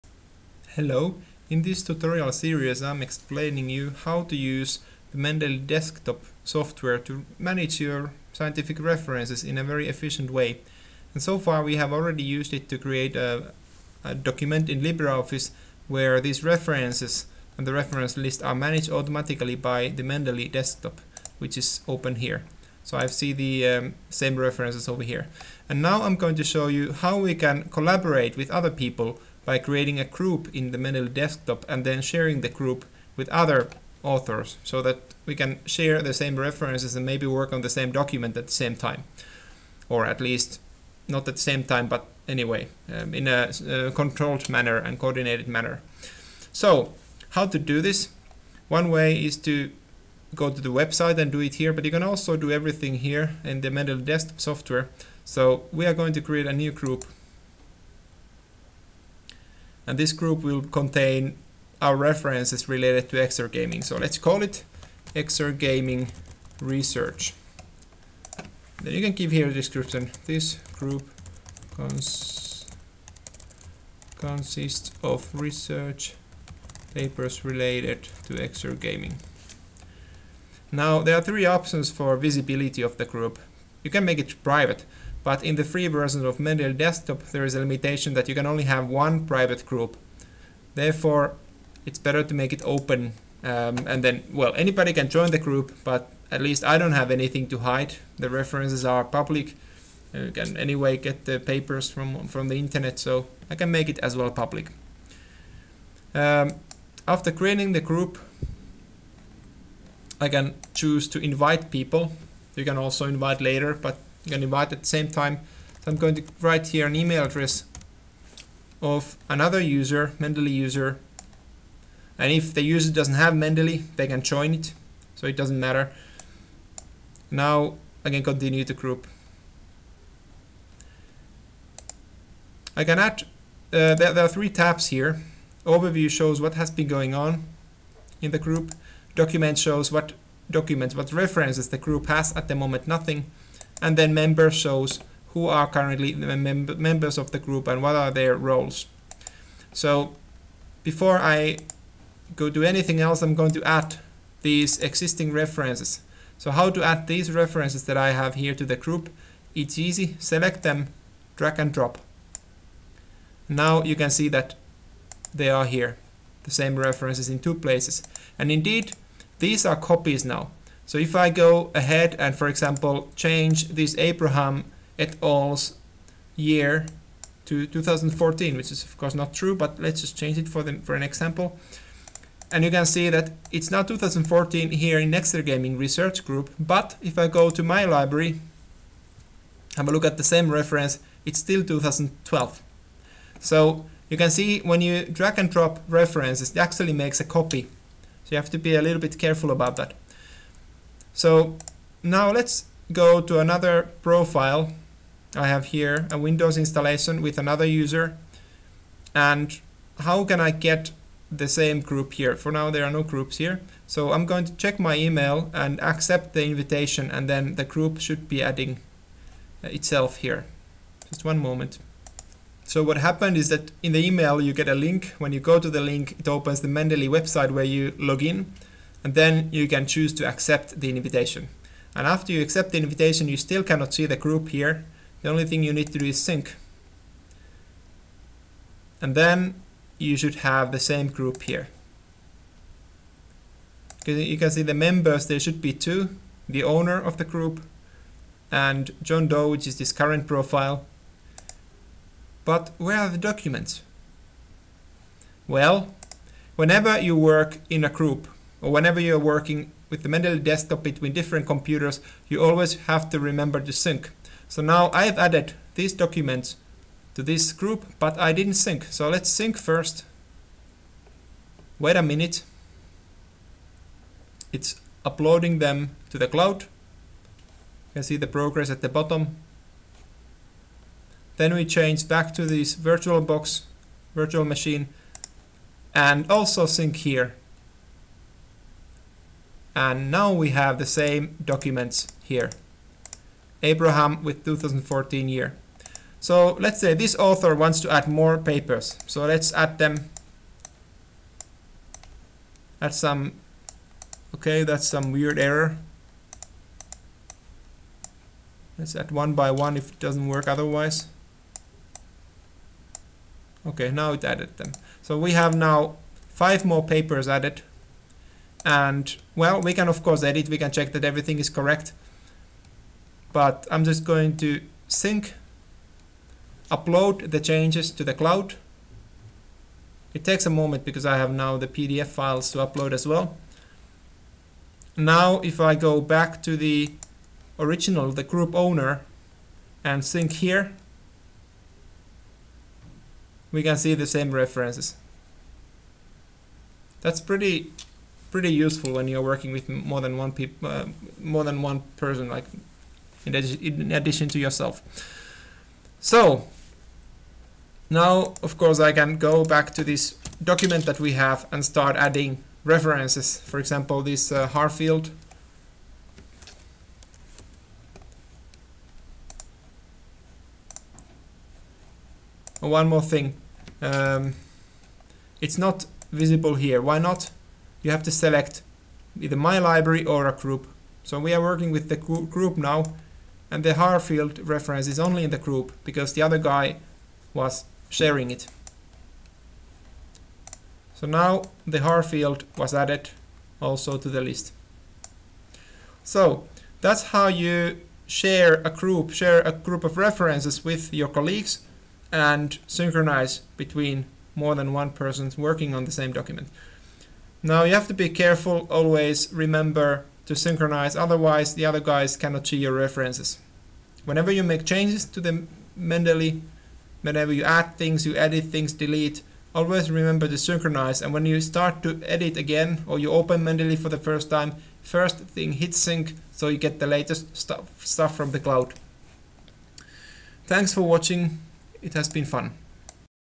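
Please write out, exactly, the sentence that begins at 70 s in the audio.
This group cons consists of research papers related to XR gaming.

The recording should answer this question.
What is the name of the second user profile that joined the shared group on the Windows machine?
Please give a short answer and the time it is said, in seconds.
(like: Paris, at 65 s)
John Doe, at 249 s.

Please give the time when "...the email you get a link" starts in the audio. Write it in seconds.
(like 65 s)
223 s.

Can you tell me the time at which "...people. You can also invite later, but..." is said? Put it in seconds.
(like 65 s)
111 s.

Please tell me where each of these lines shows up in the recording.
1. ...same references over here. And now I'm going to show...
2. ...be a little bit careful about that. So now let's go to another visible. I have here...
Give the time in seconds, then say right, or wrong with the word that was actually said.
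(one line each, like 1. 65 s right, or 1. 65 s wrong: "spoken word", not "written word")
1. 24 s right
2. 198 s wrong: "profile", not "visible".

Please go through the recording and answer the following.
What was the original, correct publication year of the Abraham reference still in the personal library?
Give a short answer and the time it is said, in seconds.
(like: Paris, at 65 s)
2012, at 191 s.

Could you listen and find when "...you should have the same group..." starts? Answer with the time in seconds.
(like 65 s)
239 s.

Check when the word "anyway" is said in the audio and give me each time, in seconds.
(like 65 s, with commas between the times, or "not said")
42 s, 100 s.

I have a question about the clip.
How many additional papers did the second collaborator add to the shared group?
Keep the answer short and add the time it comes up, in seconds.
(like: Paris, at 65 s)
5, at 316 s.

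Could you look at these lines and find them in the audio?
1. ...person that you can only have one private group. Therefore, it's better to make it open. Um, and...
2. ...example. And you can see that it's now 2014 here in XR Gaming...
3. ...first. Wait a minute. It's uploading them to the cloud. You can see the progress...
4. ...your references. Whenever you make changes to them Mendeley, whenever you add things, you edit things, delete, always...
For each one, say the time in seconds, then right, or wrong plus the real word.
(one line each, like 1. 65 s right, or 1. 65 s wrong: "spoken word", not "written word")
1. 87 s wrong: "limitation", not "person"
2. 181 s right
3. 269 s right
4. 412 s right.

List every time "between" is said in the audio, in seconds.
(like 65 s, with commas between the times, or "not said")
260 s, 403 s.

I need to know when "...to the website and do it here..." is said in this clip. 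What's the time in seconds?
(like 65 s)
50 s.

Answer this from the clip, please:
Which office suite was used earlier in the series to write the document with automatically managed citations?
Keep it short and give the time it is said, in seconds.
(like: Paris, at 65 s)
LibreOffice, at 14 s.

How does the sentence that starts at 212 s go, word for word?
For now, there are no groups here.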